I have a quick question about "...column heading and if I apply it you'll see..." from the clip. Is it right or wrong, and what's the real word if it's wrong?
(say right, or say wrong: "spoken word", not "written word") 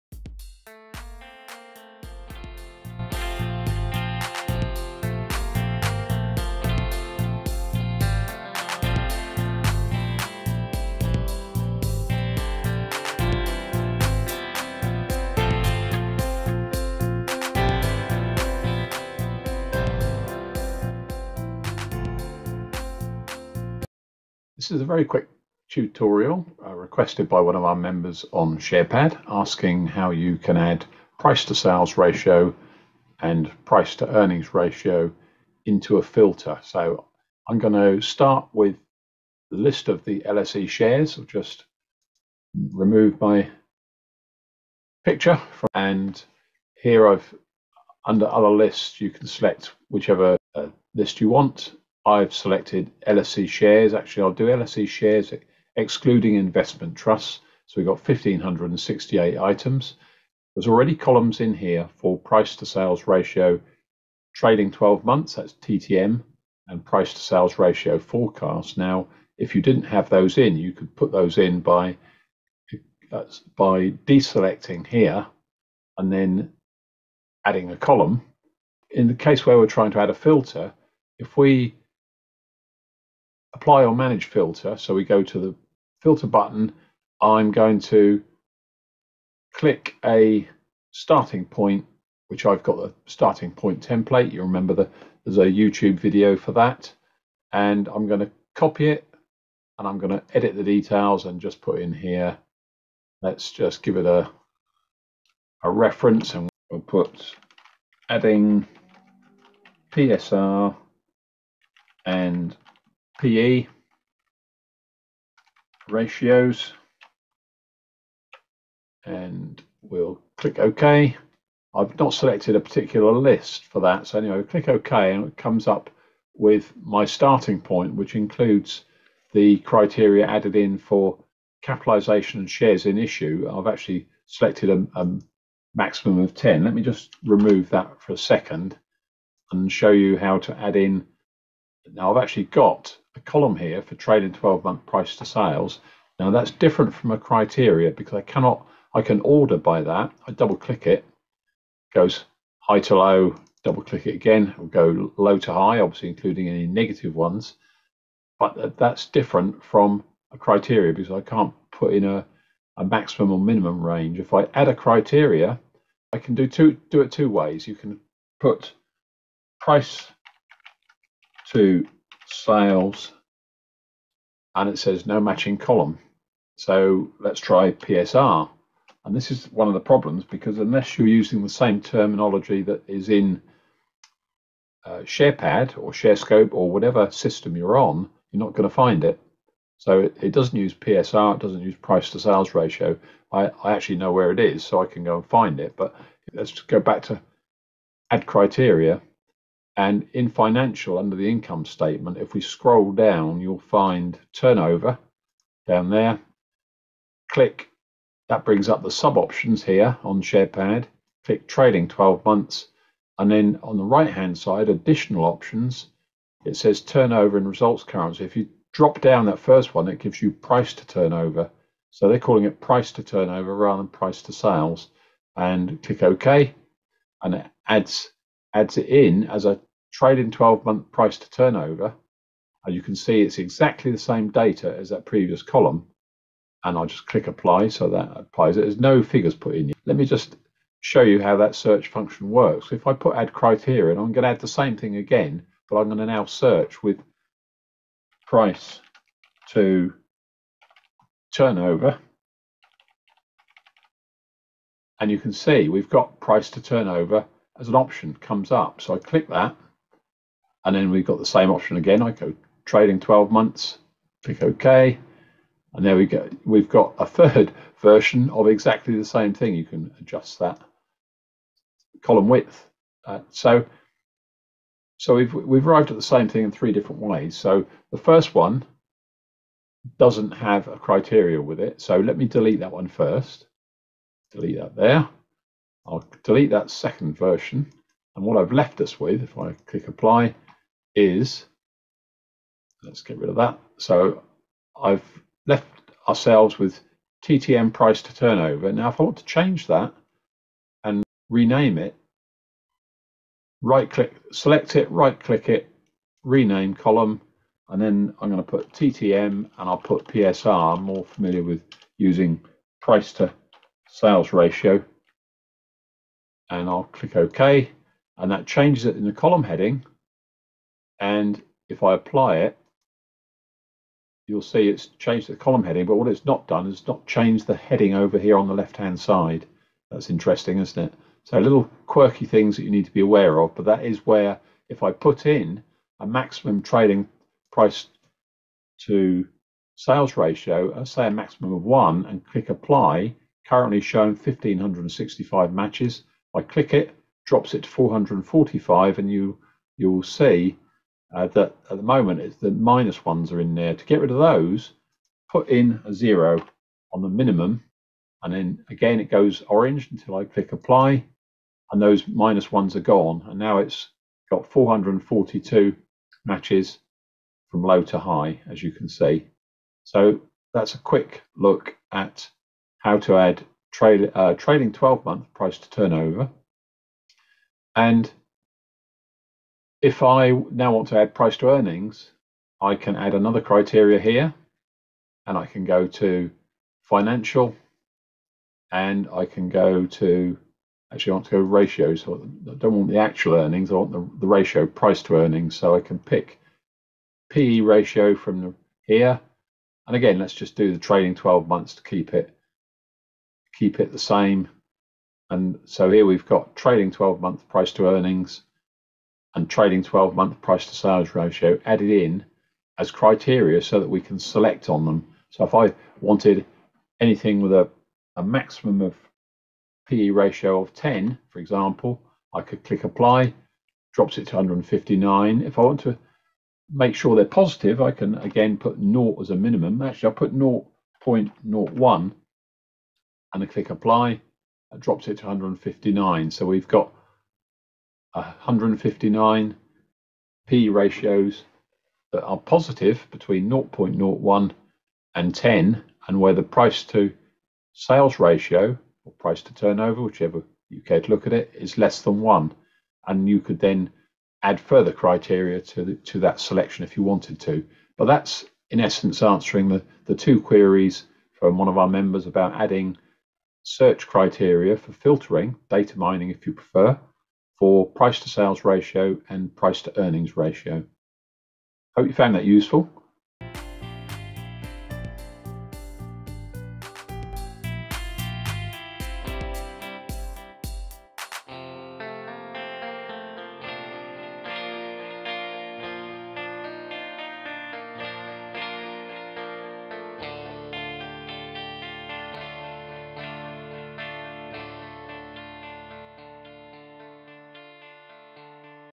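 right.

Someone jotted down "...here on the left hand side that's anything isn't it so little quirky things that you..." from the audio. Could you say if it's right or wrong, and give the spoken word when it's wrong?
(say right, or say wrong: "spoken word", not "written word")
wrong: "interesting", not "anything".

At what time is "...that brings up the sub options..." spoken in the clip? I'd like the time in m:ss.
3:28.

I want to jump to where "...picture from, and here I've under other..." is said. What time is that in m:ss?
0:45.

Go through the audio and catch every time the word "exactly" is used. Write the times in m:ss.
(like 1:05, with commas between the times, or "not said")
3:53, 4:28.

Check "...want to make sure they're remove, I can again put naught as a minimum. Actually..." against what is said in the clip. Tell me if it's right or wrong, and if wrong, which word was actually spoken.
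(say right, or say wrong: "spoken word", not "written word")
wrong: "positive", not "remove".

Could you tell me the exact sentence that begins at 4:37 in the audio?
So the first one doesn't have a criteria with it.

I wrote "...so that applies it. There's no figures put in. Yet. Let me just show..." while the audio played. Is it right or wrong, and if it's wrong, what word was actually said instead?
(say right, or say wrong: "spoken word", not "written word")
right.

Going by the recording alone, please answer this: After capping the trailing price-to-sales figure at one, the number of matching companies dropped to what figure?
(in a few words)
445.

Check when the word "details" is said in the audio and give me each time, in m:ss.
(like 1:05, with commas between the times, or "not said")
1:40.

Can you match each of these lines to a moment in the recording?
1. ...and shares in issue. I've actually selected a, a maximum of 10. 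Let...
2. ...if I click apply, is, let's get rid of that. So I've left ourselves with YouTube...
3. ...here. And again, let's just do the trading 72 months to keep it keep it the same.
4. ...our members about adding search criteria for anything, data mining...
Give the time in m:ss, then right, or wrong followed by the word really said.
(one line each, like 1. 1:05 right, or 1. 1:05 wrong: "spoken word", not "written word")
1. 2:12 right
2. 4:49 wrong: "TTM", not "YouTube"
3. 6:38 wrong: "12", not "72"
4. 7:41 wrong: "filtering", not "anything".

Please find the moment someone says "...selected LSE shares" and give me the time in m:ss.
0:52.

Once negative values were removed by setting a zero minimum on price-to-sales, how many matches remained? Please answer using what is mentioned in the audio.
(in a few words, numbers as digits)
442.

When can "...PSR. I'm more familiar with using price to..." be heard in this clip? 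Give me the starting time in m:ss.
5:10.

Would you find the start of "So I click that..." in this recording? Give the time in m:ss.
4:18.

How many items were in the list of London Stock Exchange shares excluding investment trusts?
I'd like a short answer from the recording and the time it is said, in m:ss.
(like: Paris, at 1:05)
1,568, at 0:58.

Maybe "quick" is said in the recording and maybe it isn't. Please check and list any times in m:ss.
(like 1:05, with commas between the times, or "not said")
0:25, 6:10.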